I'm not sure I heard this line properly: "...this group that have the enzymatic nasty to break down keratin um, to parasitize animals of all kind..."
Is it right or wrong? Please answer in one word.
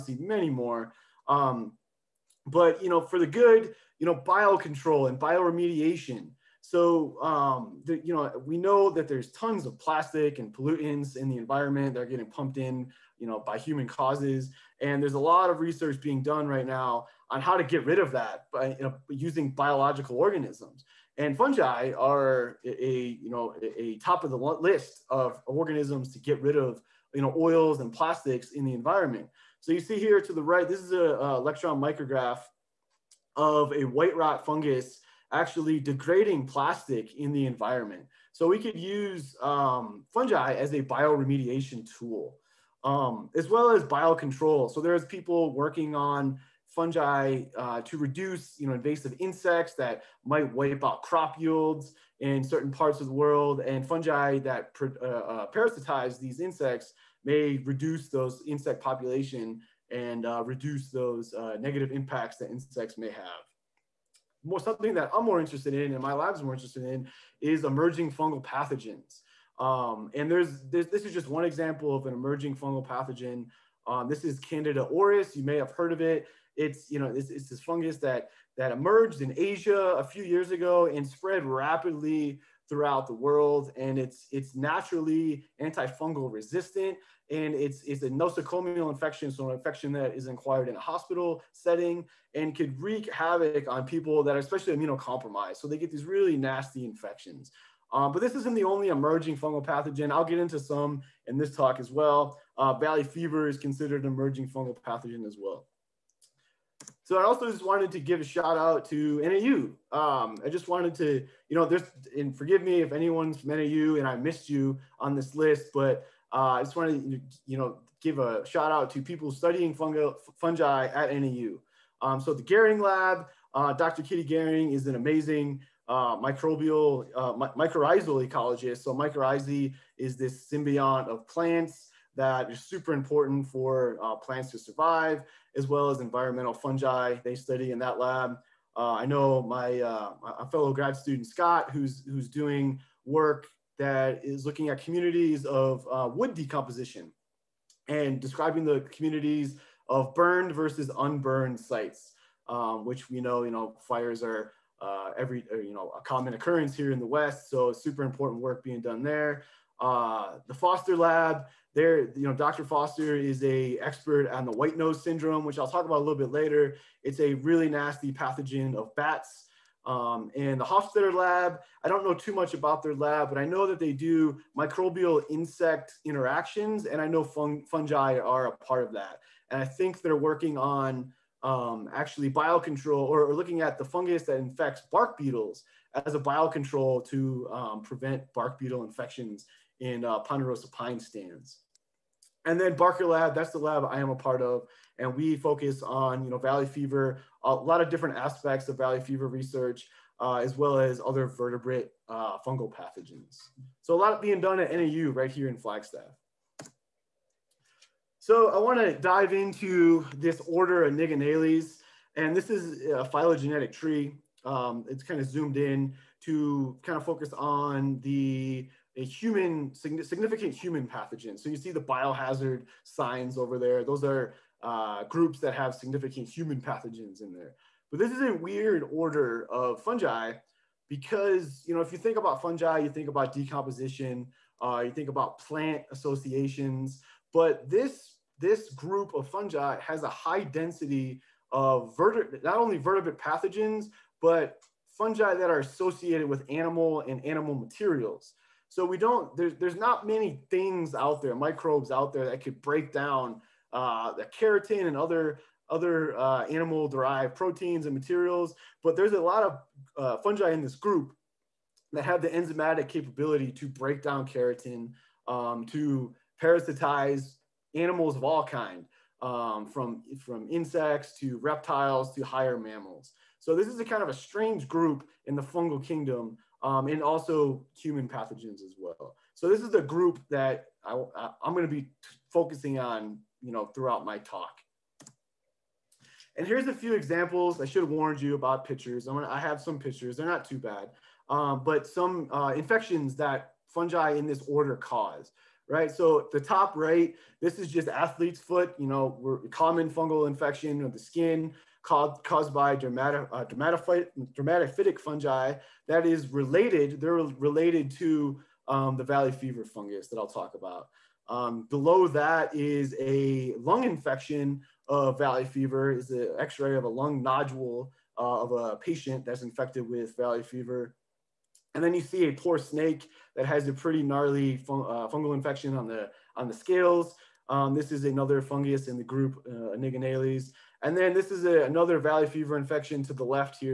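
wrong.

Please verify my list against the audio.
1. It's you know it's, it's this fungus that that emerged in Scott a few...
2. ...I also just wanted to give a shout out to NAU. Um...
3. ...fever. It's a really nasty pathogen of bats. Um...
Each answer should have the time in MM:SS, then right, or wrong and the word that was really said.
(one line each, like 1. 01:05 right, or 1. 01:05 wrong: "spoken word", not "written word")
1. 01:16 wrong: "Asia", not "Scott"
2. 01:47 right
3. 02:46 wrong: "later", not "fever".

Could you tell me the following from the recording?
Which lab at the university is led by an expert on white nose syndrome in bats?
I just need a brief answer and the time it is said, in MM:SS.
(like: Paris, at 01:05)
Foster Lab, at 02:40.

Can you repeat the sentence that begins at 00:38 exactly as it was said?
So we could use um, fungi as a bioremediation tool um, as well as biocontrol.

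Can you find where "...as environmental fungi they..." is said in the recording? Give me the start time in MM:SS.
02:15.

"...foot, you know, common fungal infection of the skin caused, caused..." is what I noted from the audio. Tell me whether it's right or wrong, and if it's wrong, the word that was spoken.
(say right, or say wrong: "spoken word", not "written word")
right.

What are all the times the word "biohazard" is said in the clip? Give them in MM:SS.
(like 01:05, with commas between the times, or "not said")
03:41.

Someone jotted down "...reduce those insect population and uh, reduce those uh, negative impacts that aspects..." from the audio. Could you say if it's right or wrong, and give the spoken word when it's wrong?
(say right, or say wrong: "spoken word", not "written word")
wrong: "insects", not "aspects".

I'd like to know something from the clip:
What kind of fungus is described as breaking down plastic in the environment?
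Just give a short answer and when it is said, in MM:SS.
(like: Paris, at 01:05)
white rot fungus, at 00:33.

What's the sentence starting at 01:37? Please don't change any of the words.
Um, but this isn't the only emerging fungal pathogen.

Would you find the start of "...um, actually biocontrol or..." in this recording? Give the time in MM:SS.
03:01.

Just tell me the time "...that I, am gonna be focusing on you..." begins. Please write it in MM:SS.
04:40.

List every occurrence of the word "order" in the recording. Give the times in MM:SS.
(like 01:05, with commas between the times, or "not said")
03:30, 03:48, 04:54.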